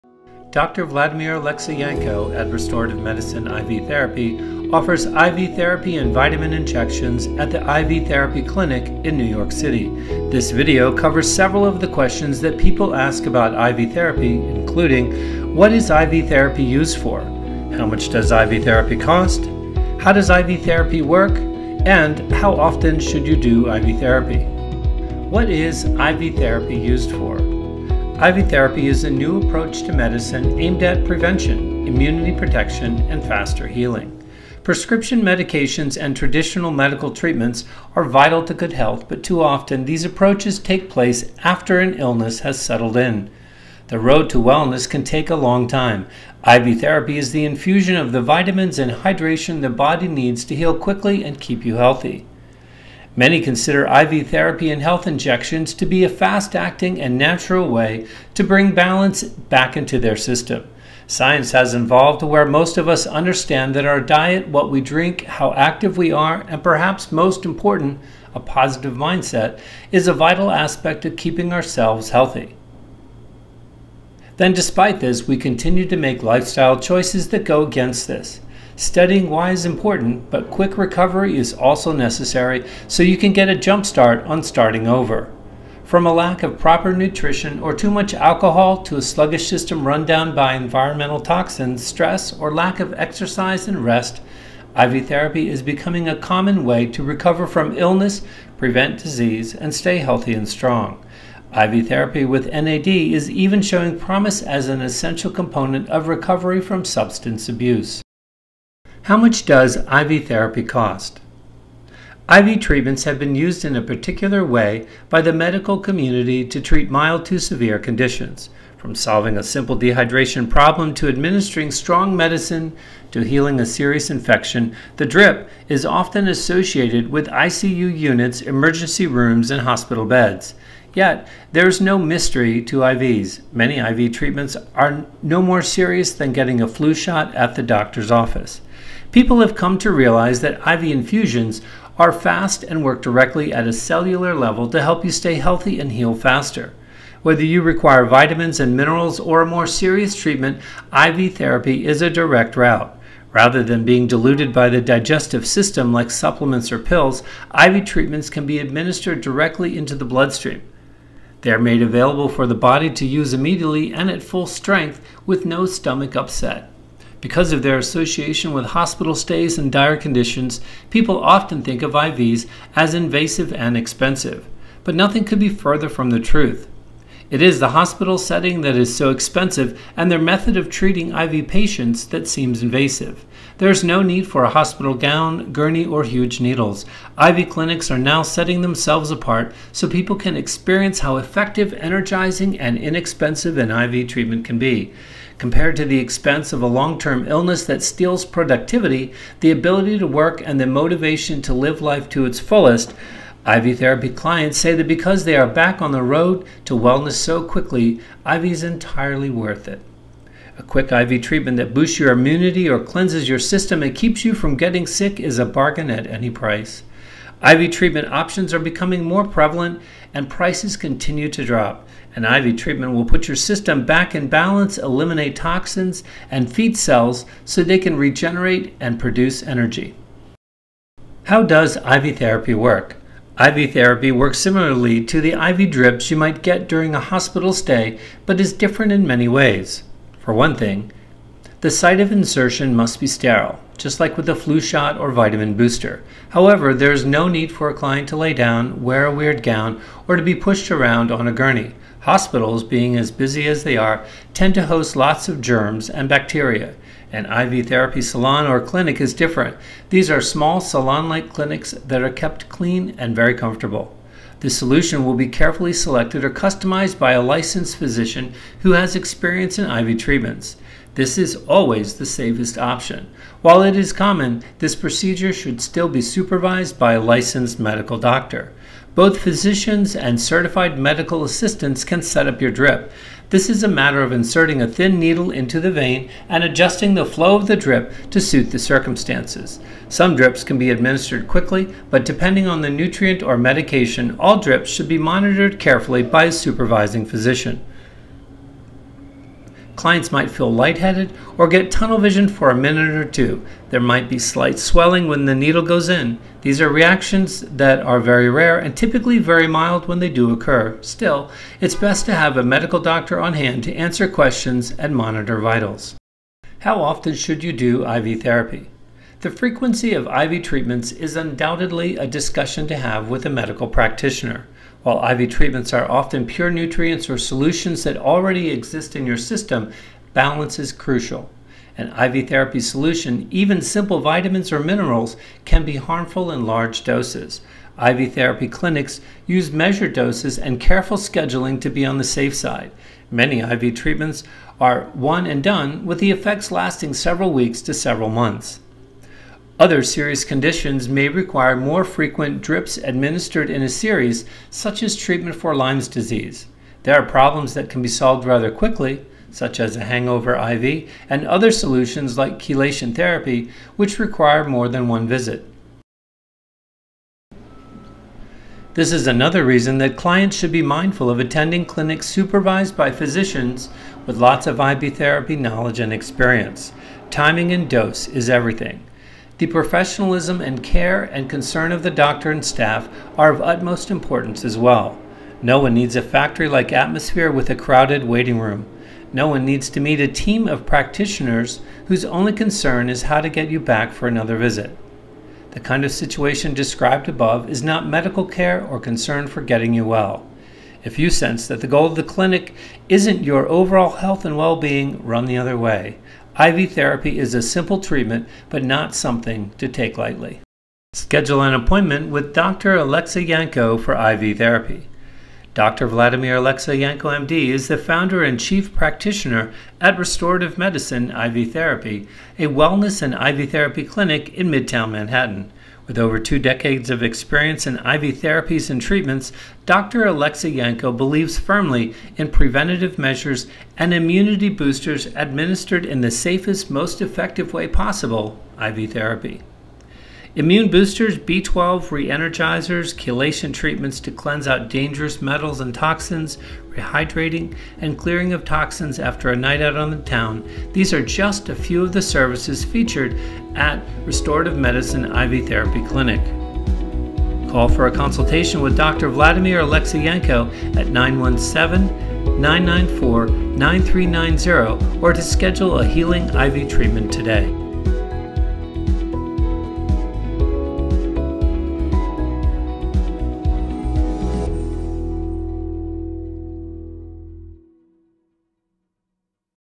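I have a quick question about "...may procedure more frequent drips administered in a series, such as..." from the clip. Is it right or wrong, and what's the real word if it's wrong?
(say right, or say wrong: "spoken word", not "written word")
wrong: "require", not "procedure".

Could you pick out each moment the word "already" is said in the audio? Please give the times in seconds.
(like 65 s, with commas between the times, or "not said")
327 s.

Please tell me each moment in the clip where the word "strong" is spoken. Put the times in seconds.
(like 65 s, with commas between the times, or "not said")
100 s, 121 s.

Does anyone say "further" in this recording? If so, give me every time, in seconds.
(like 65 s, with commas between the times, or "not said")
175 s.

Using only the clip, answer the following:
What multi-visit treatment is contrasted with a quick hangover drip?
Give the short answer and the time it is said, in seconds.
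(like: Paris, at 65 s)
chelation therapy, at 362 s.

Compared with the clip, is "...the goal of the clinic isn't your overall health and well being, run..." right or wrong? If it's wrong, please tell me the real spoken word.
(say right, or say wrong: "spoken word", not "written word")
right.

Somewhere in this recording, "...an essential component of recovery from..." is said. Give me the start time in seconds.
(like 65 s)
104 s.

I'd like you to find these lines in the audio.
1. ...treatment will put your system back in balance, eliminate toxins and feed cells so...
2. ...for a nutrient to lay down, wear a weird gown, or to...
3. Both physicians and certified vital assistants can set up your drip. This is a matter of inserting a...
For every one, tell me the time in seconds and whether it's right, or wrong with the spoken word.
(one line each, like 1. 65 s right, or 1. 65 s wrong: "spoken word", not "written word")
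1. 222 s right
2. 247 s wrong: "client", not "nutrient"
3. 278 s wrong: "medical", not "vital".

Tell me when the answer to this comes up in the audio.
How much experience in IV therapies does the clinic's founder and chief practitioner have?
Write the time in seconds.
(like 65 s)
425 s.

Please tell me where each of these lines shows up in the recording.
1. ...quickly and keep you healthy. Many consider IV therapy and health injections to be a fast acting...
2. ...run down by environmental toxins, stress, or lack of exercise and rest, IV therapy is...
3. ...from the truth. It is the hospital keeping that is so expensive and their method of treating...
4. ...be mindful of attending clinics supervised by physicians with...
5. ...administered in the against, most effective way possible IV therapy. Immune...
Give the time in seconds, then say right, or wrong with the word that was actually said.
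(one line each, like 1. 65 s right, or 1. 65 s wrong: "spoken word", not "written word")
1. 50 s right
2. 89 s right
3. 175 s wrong: "setting", not "keeping"
4. 370 s right
5. 435 s wrong: "safest", not "against".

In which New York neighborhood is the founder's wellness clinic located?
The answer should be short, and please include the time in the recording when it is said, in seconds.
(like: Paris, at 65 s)
Midtown Manhattan, at 424 s.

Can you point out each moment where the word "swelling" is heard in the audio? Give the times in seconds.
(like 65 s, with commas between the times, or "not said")
304 s.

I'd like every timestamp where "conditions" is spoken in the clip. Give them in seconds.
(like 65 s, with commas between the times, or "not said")
117 s, 169 s, 350 s.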